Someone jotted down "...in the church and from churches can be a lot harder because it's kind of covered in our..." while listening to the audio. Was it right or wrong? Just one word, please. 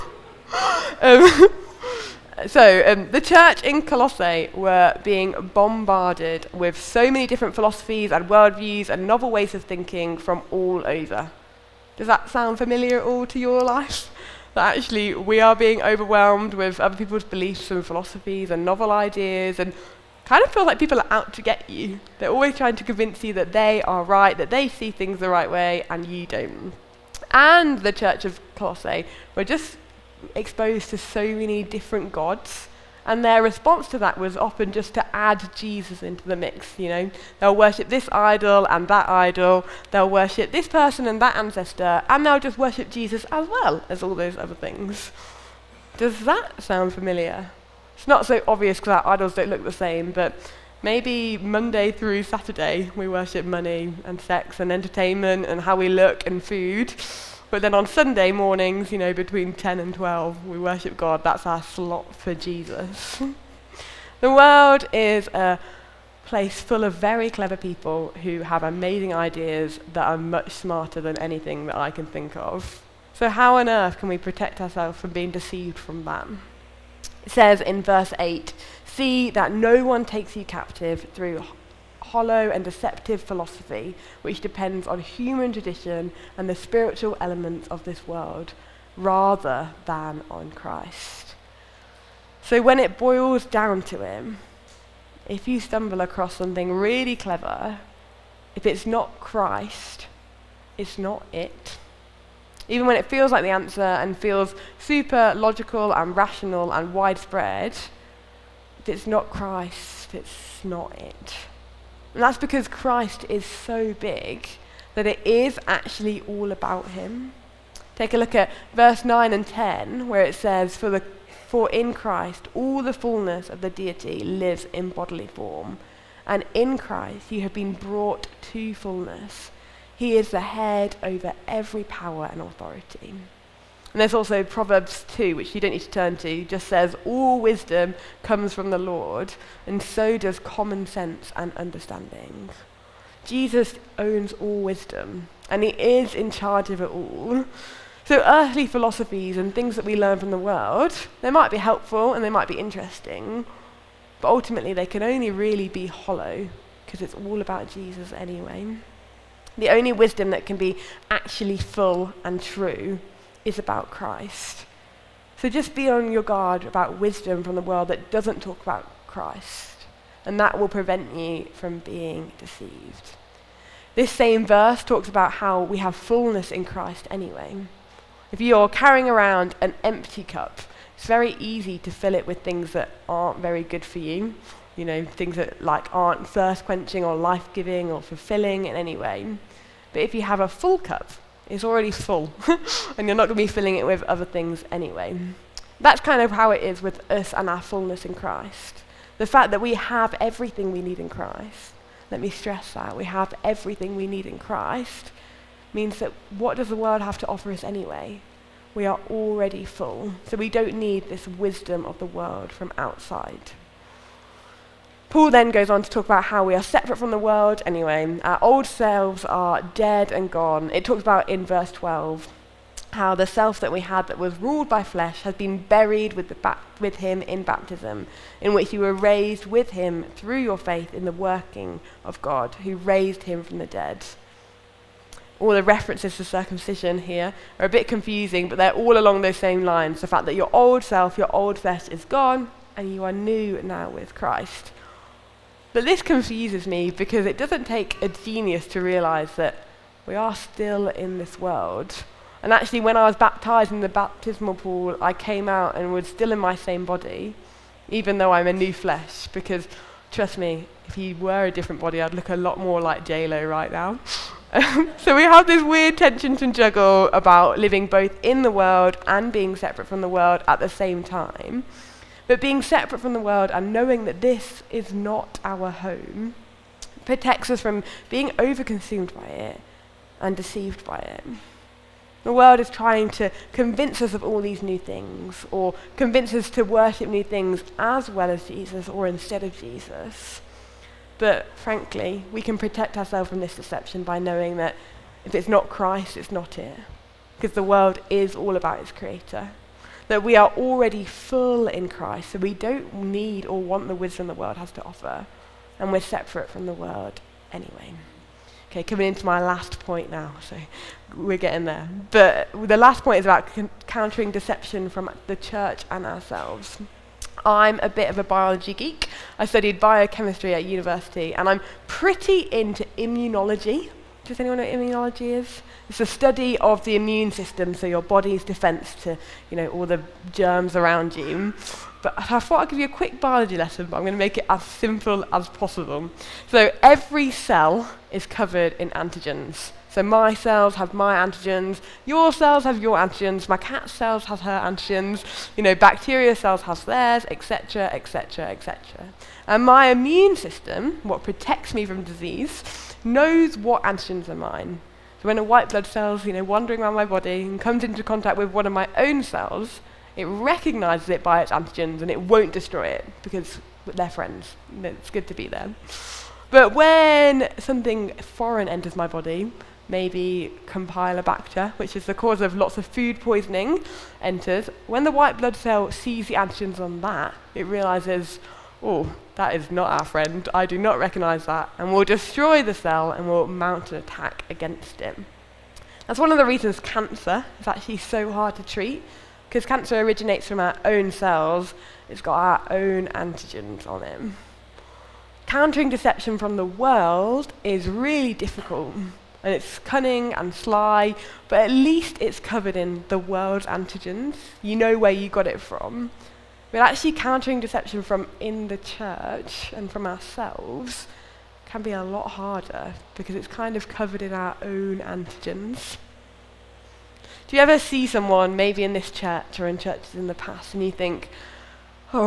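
wrong.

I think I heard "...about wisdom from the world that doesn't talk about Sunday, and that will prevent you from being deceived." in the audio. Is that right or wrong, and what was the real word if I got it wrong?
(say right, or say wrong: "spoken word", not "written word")
wrong: "Christ", not "Sunday".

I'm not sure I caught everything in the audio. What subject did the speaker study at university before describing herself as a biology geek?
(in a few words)
biochemistry.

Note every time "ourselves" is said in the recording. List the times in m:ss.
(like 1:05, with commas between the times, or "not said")
1:14, 4:52, 5:16, 6:50.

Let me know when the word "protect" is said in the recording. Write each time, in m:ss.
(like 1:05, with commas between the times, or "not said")
1:14, 4:37, 4:52, 5:51.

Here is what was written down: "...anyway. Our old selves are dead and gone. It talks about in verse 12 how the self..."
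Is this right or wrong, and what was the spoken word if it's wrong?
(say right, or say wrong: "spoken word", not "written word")
right.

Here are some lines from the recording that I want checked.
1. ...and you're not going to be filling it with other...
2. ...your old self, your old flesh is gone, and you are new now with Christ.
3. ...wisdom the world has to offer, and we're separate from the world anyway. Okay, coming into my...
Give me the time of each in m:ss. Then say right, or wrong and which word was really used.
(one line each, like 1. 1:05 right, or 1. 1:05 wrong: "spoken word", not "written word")
1. 3:12 right
2. 4:00 right
3. 5:03 right.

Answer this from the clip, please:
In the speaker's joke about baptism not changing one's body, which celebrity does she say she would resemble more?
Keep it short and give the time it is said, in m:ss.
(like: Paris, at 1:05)
JLo, at 4:23.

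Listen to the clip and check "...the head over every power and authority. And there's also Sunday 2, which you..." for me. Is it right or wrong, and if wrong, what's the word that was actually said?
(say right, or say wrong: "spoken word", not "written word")
wrong: "Proverbs", not "Sunday".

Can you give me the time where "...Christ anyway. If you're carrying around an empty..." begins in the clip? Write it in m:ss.
2:56.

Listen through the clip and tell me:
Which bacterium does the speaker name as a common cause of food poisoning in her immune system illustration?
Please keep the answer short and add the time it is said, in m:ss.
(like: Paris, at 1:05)
Campylobacter, at 6:10.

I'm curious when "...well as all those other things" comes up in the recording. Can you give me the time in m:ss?
0:43.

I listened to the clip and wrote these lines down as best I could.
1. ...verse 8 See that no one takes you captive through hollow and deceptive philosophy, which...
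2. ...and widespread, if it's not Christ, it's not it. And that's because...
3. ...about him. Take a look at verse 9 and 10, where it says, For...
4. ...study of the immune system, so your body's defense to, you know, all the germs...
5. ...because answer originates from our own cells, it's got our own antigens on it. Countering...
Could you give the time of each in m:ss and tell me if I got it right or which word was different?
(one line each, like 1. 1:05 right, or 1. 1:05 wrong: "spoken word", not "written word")
1. 1:17 right
2. 1:46 right
3. 1:56 right
4. 5:26 right
5. 6:29 wrong: "cancer", not "answer".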